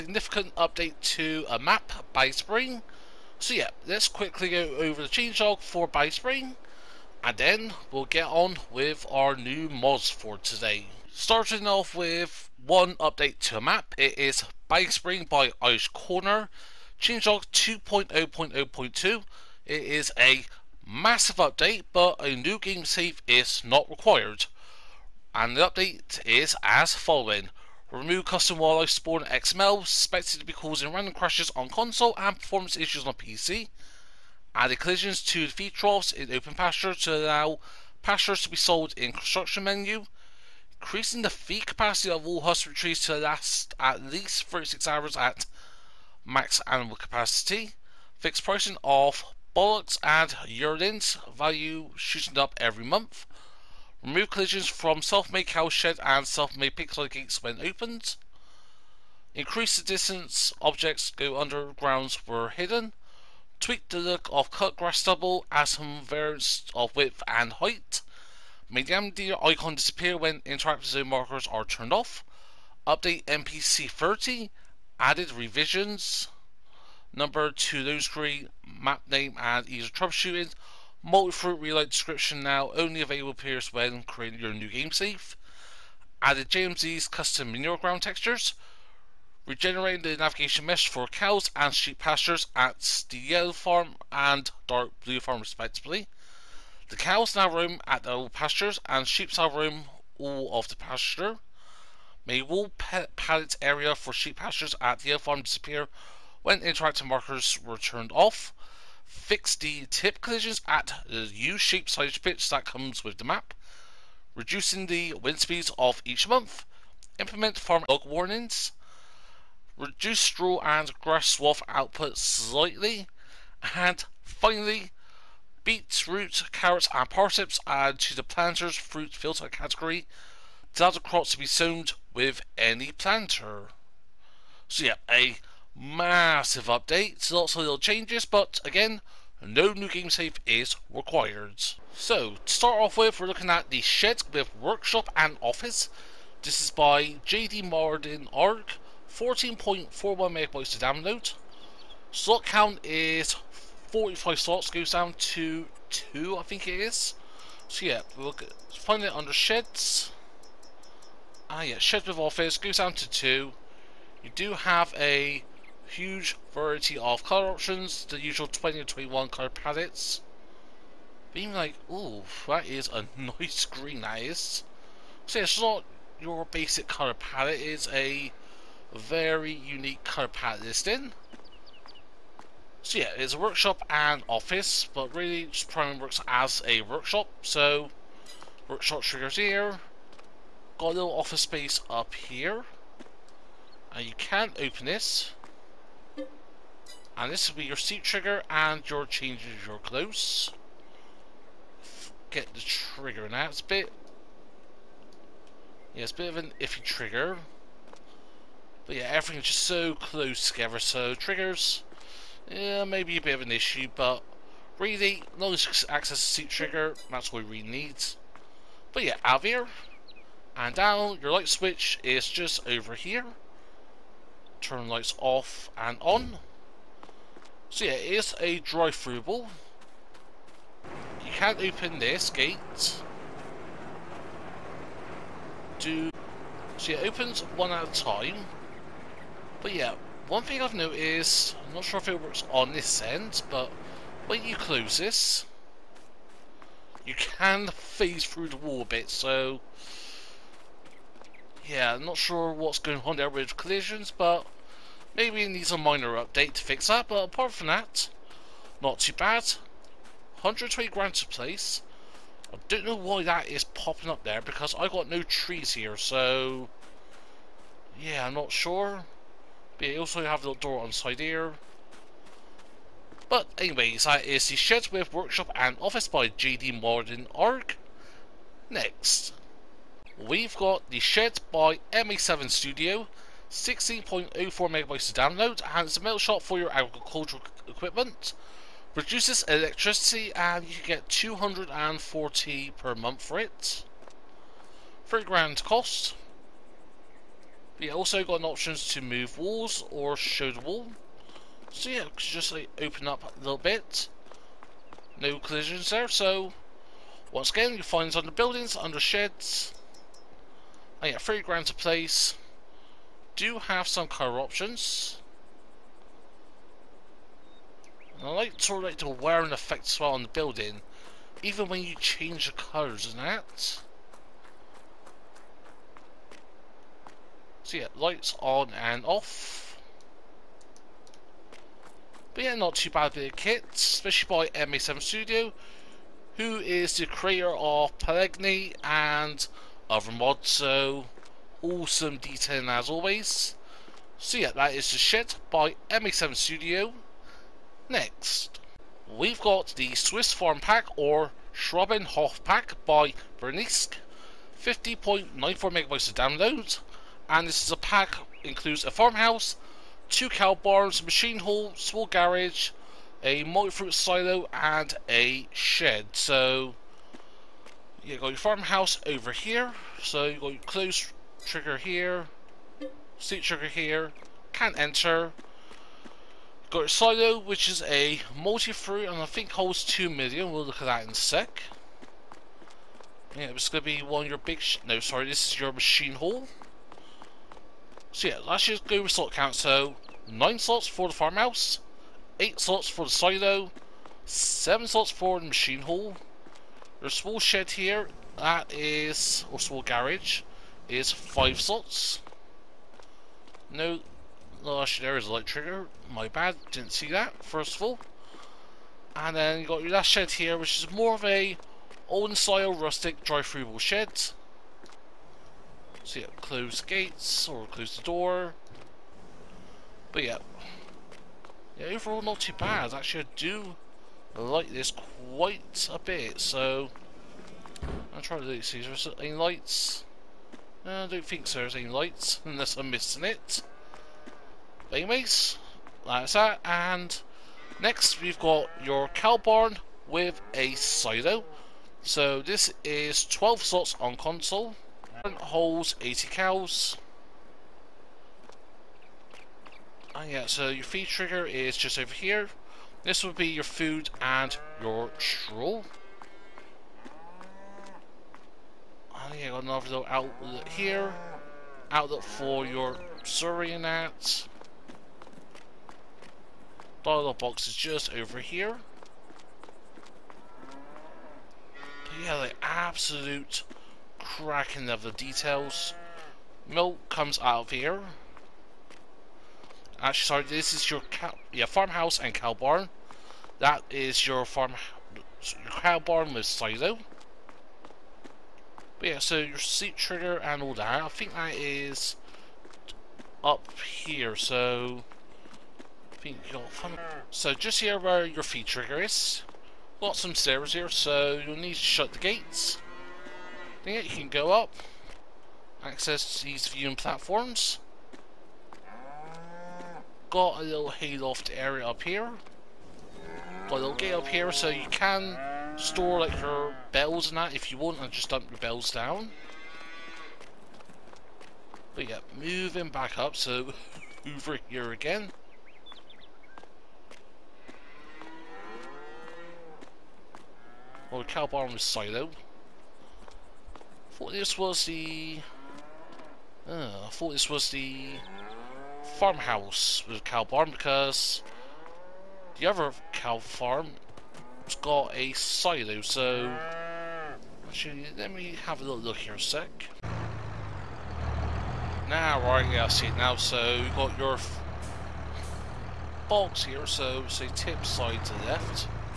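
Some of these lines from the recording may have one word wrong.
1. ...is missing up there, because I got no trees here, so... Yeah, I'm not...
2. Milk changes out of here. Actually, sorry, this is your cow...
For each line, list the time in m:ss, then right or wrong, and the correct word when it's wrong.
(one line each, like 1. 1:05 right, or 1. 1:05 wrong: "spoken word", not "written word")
1. 4:23 wrong: "popping", not "missing"
2. 7:56 wrong: "comes", not "changes".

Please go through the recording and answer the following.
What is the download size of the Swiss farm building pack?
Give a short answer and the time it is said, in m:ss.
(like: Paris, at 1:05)
50.94 megabytes, at 5:54.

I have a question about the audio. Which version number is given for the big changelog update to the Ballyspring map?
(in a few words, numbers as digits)
2.0.0.2.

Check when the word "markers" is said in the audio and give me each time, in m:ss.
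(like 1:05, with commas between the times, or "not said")
1:11, 1:47.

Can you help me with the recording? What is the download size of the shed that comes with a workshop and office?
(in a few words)
14.41 megabytes.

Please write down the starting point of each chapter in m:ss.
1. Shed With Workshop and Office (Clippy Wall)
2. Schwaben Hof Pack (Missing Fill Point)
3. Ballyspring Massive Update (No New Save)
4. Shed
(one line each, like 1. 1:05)
1. 2:21
2. 5:47
3. 0:10
4. 4:39.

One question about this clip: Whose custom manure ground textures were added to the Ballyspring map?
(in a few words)
JMZ.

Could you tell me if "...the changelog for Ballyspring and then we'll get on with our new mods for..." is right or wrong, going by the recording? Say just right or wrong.
right.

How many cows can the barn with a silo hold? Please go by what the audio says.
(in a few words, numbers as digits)
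80.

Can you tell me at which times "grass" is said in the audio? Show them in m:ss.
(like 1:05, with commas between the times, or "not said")
1:04, 2:01.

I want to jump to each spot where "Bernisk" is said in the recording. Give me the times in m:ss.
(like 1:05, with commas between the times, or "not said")
5:53.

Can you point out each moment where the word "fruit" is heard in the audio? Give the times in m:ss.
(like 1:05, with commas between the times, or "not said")
1:21, 2:08, 6:03, 6:18.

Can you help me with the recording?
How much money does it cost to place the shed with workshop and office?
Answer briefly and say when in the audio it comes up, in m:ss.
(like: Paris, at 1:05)
120 grand, at 4:20.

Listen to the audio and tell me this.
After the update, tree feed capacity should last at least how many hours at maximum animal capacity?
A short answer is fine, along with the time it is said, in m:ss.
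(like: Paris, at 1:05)
36 hours, at 0:44.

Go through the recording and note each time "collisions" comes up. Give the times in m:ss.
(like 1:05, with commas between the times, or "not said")
0:34, 0:54, 1:50, 4:13, 5:05.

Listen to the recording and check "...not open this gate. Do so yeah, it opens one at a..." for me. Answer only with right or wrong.
right.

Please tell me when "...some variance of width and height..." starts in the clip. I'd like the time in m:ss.
1:05.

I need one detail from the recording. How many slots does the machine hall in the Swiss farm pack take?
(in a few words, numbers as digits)
7.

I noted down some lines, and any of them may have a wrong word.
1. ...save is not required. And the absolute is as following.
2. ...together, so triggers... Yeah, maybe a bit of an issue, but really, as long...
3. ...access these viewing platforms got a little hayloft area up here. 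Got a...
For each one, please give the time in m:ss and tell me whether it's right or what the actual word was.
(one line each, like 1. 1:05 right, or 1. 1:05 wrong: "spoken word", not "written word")
1. 0:22 wrong: "update", not "absolute"
2. 3:30 right
3. 8:25 right.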